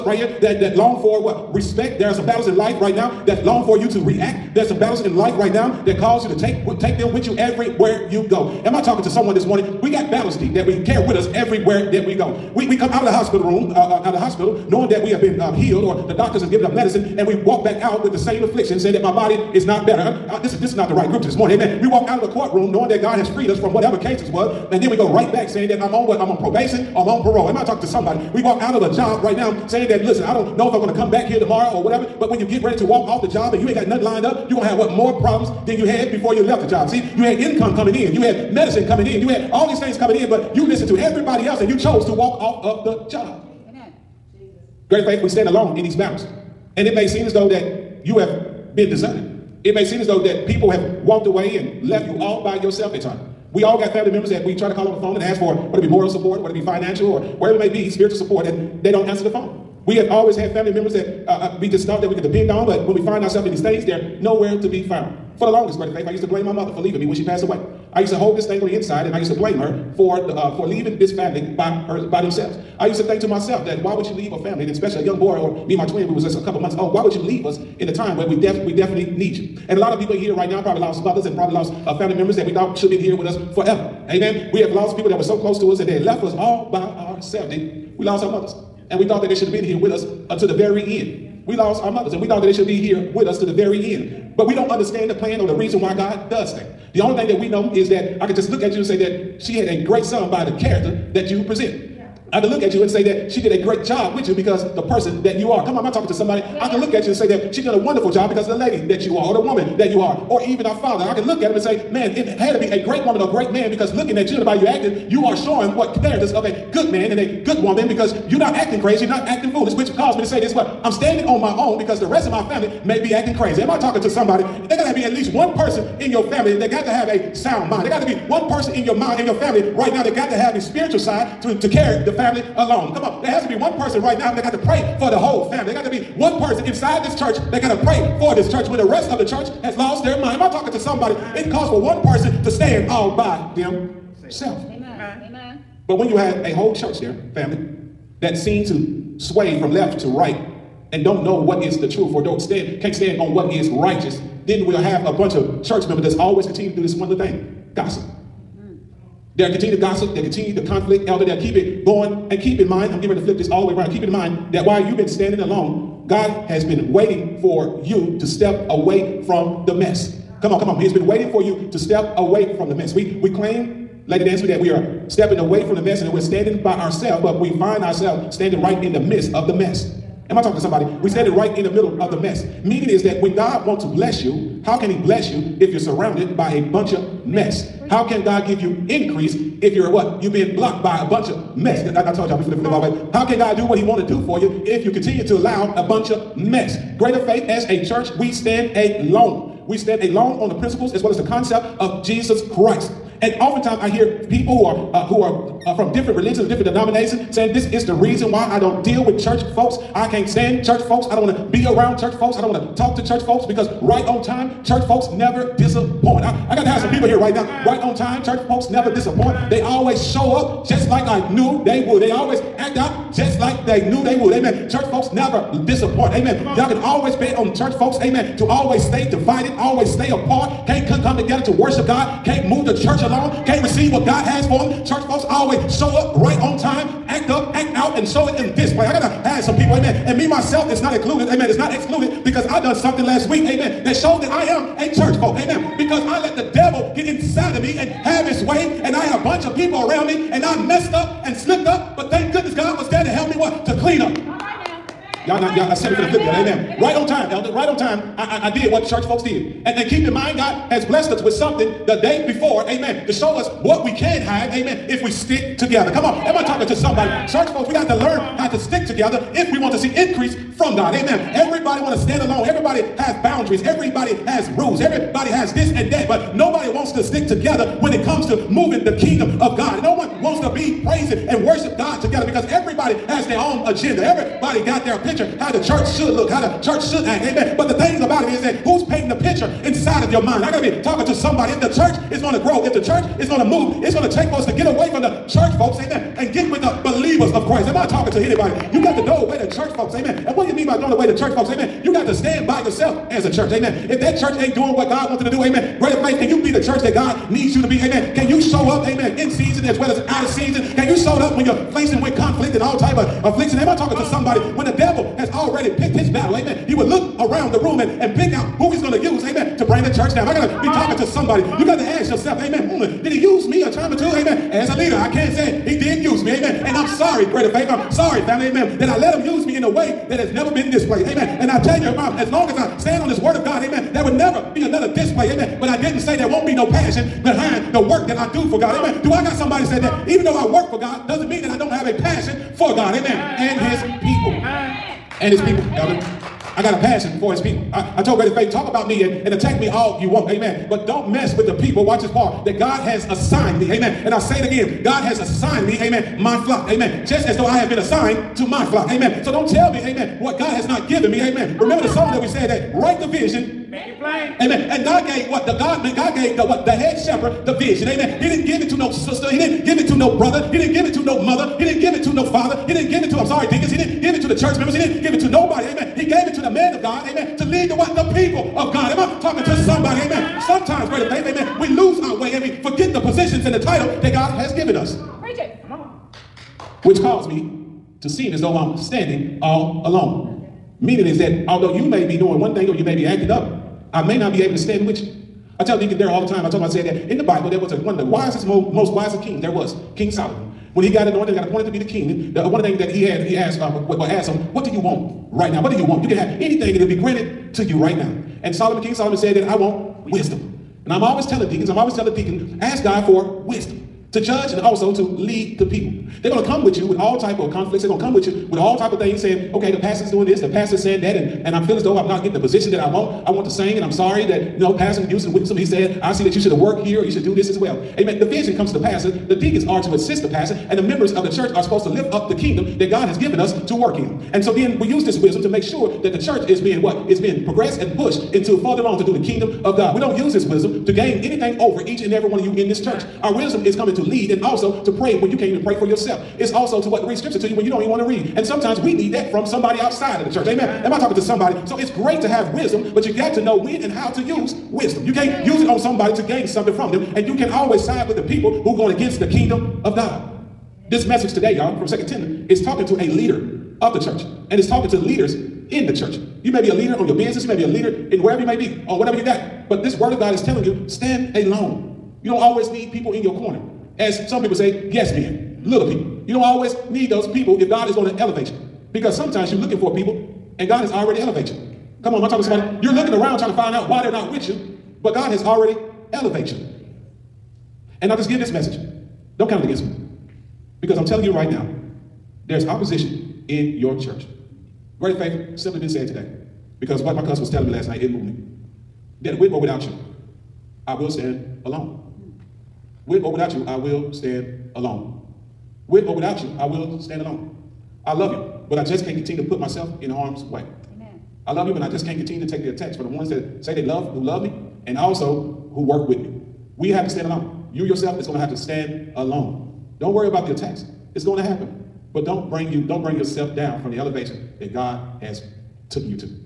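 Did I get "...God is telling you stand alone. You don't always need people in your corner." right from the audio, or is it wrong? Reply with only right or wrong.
right.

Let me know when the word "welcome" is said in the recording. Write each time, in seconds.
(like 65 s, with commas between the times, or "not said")
not said.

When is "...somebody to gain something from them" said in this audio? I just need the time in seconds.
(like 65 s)
455 s.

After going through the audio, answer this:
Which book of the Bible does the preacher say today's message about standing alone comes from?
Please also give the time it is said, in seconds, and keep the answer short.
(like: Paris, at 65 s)
Second Timothy, at 461 s.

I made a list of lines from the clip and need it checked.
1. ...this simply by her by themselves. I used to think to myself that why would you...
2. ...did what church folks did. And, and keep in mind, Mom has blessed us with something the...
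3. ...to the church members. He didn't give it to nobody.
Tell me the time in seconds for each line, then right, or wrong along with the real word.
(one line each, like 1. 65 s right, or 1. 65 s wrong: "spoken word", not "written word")
1. 70 s wrong: "family", not "simply"
2. 258 s wrong: "God", not "Mom"
3. 374 s right.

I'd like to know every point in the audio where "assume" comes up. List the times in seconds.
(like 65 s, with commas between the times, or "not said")
not said.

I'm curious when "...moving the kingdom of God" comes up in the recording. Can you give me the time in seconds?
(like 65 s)
278 s.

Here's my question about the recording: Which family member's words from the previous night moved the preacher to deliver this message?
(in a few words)
cousin.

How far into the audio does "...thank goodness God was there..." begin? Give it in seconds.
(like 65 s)
252 s.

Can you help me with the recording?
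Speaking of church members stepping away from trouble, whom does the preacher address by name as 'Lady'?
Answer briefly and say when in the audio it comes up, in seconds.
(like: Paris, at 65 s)
Lady Nancy, at 174 s.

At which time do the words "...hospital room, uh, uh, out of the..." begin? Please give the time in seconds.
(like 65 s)
13 s.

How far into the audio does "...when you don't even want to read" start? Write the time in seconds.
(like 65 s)
447 s.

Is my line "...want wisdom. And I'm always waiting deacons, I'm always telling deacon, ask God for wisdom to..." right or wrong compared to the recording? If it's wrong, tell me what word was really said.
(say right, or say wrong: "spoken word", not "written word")
wrong: "telling", not "waiting".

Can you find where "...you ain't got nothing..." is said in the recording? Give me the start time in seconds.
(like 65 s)
33 s.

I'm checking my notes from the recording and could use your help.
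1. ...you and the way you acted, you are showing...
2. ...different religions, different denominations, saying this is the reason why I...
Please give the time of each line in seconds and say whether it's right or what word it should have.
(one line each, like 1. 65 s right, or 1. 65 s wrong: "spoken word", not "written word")
1. 114 s right
2. 205 s right.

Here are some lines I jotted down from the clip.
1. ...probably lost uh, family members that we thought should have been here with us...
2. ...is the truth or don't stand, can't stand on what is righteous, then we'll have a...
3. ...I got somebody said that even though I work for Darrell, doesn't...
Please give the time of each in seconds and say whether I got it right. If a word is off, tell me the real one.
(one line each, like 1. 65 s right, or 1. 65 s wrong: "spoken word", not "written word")
1. 81 s right
2. 151 s right
3. 339 s wrong: "God", not "Darrell".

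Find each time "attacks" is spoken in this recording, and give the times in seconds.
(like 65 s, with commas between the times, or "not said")
349 s, 512 s, 520 s.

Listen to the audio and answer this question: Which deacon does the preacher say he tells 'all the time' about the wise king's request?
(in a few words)
Deacon Darrell.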